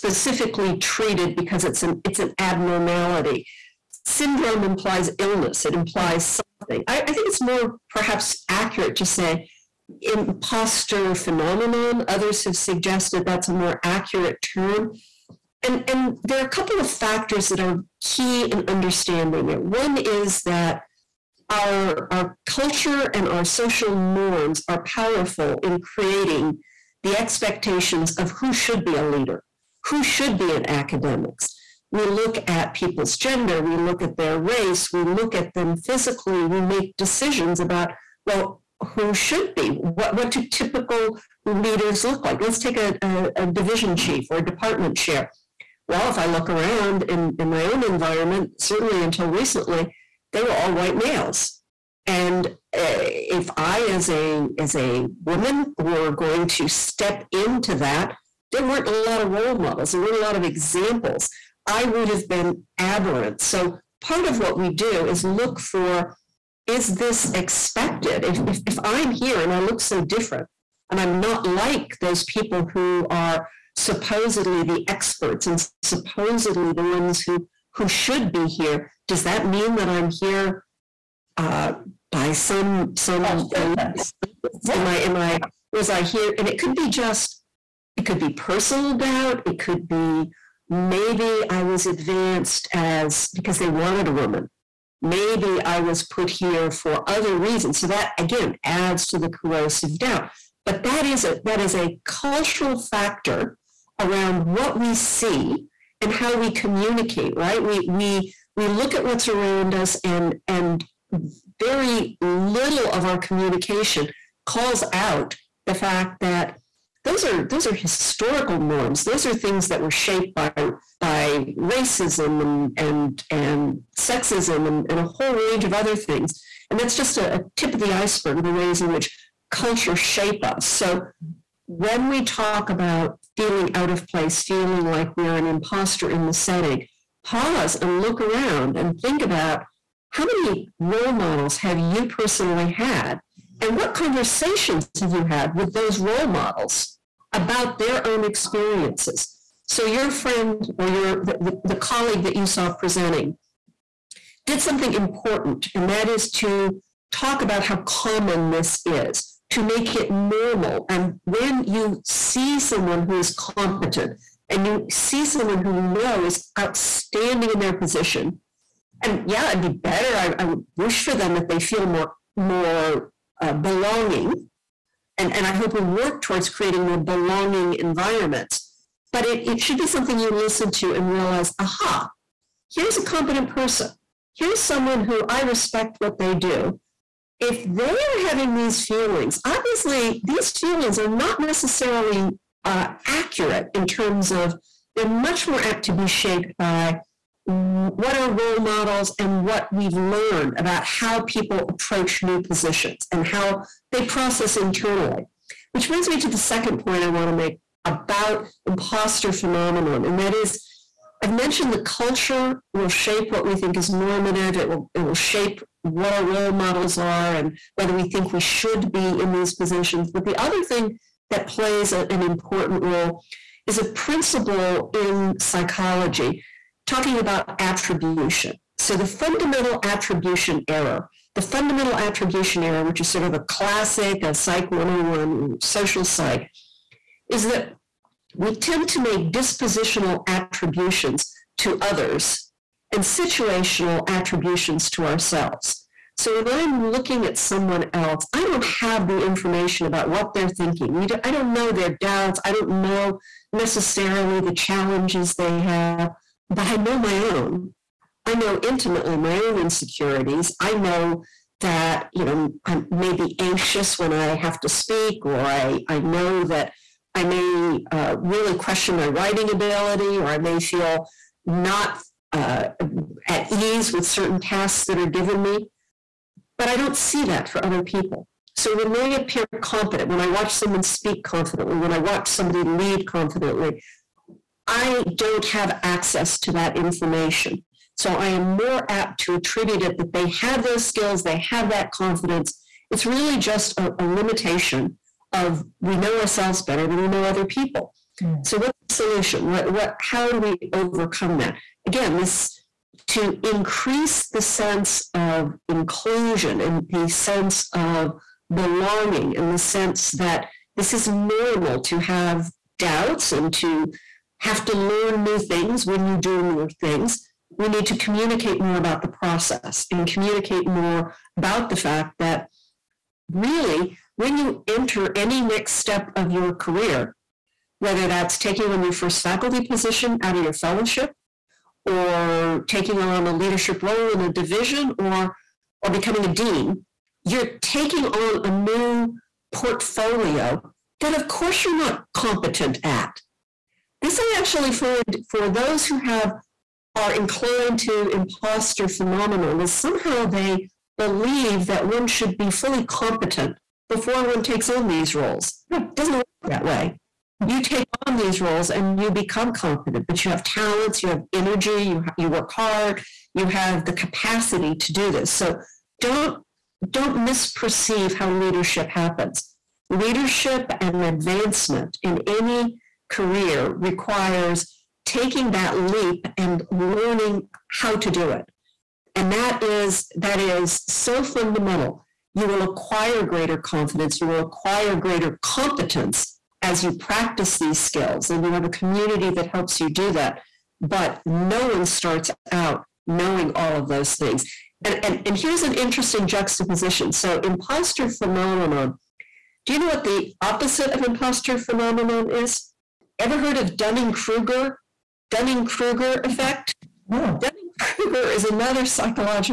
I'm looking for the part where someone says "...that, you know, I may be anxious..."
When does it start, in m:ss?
4:21.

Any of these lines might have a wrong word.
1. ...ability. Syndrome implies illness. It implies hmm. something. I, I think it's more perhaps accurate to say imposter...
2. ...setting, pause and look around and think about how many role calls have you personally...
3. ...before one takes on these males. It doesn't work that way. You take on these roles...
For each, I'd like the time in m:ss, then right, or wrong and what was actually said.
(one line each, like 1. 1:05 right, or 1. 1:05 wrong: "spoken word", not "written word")
1. 0:02 wrong: "abnormality", not "ability"
2. 2:16 wrong: "models", not "calls"
3. 5:53 wrong: "roles", not "males".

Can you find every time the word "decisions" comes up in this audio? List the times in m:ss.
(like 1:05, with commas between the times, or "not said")
0:36.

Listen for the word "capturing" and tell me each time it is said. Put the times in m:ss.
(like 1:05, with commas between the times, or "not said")
not said.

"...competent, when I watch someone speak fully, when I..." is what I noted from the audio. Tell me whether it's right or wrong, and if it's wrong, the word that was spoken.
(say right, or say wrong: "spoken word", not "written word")
wrong: "confidently", not "fully".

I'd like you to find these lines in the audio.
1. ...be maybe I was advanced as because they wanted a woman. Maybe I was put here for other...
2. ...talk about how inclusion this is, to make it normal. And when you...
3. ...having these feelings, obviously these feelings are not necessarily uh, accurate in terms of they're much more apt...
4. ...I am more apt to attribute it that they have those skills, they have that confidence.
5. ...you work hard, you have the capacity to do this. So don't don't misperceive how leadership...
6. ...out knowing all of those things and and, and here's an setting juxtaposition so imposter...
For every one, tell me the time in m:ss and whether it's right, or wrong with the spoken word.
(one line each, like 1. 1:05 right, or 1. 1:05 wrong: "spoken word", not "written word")
1. 1:29 right
2. 2:37 wrong: "common", not "inclusion"
3. 3:08 right
4. 4:48 right
5. 6:02 right
6. 6:32 wrong: "interesting", not "setting".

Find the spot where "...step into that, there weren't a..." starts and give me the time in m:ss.
0:56.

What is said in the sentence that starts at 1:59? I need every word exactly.
Those are things that were shaped by by racism and and and sexism and, and a whole range of other things.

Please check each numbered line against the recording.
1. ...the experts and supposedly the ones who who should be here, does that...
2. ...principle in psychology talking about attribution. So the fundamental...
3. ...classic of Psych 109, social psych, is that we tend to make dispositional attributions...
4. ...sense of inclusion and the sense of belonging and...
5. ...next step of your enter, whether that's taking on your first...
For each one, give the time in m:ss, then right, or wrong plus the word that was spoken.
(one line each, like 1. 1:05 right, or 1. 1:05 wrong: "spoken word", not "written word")
1. 1:14 right
2. 3:43 right
3. 3:53 wrong: "101", not "109"
4. 5:04 right
5. 5:25 wrong: "career", not "enter".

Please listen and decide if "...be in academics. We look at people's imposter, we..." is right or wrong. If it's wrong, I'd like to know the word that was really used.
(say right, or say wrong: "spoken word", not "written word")
wrong: "gender", not "imposter".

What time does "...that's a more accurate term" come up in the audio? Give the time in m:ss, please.
0:13.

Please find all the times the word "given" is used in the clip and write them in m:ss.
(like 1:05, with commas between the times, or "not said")
4:35.